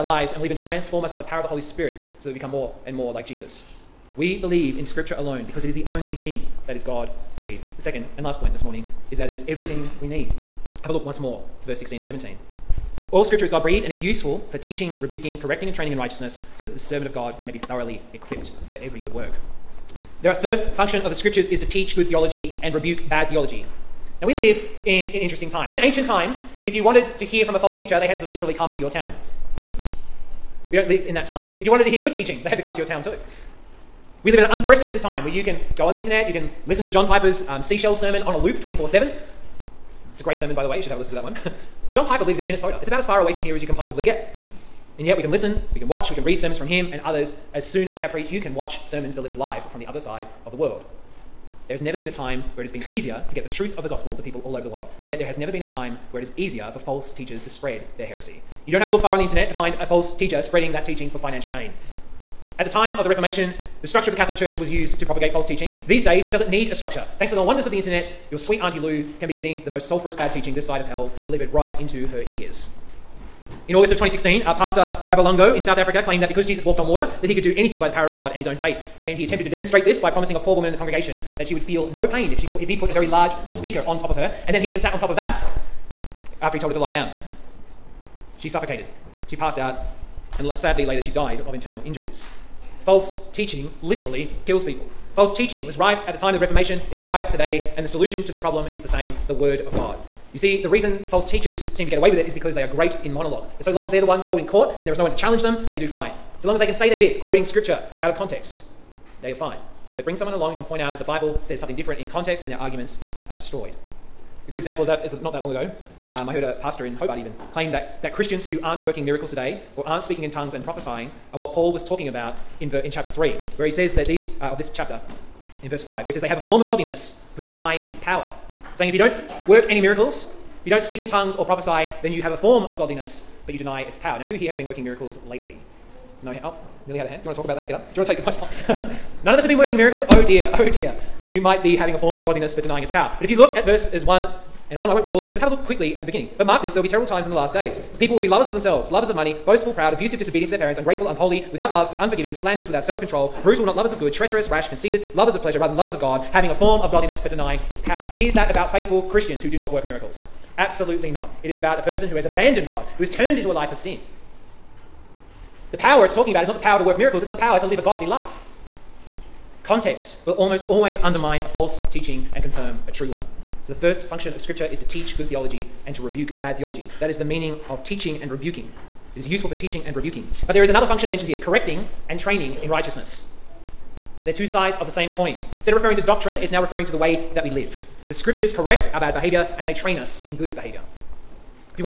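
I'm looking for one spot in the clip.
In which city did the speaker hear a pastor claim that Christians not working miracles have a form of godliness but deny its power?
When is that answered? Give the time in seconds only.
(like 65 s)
116 s.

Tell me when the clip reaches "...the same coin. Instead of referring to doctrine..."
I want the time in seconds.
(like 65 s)
184 s.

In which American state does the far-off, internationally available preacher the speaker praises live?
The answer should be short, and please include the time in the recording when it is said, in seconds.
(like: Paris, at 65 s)
Minnesota, at 42 s.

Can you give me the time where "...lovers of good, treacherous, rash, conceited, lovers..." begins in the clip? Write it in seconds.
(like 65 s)
153 s.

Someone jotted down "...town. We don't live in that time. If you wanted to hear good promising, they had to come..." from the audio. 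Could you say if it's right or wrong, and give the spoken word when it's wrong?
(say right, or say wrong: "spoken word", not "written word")
wrong: "teaching", not "promising".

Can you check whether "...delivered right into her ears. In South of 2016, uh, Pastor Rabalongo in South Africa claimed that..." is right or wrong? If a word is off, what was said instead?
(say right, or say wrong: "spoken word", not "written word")
wrong: "August", not "South".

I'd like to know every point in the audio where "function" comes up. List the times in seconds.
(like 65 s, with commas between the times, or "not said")
20 s, 174 s, 180 s.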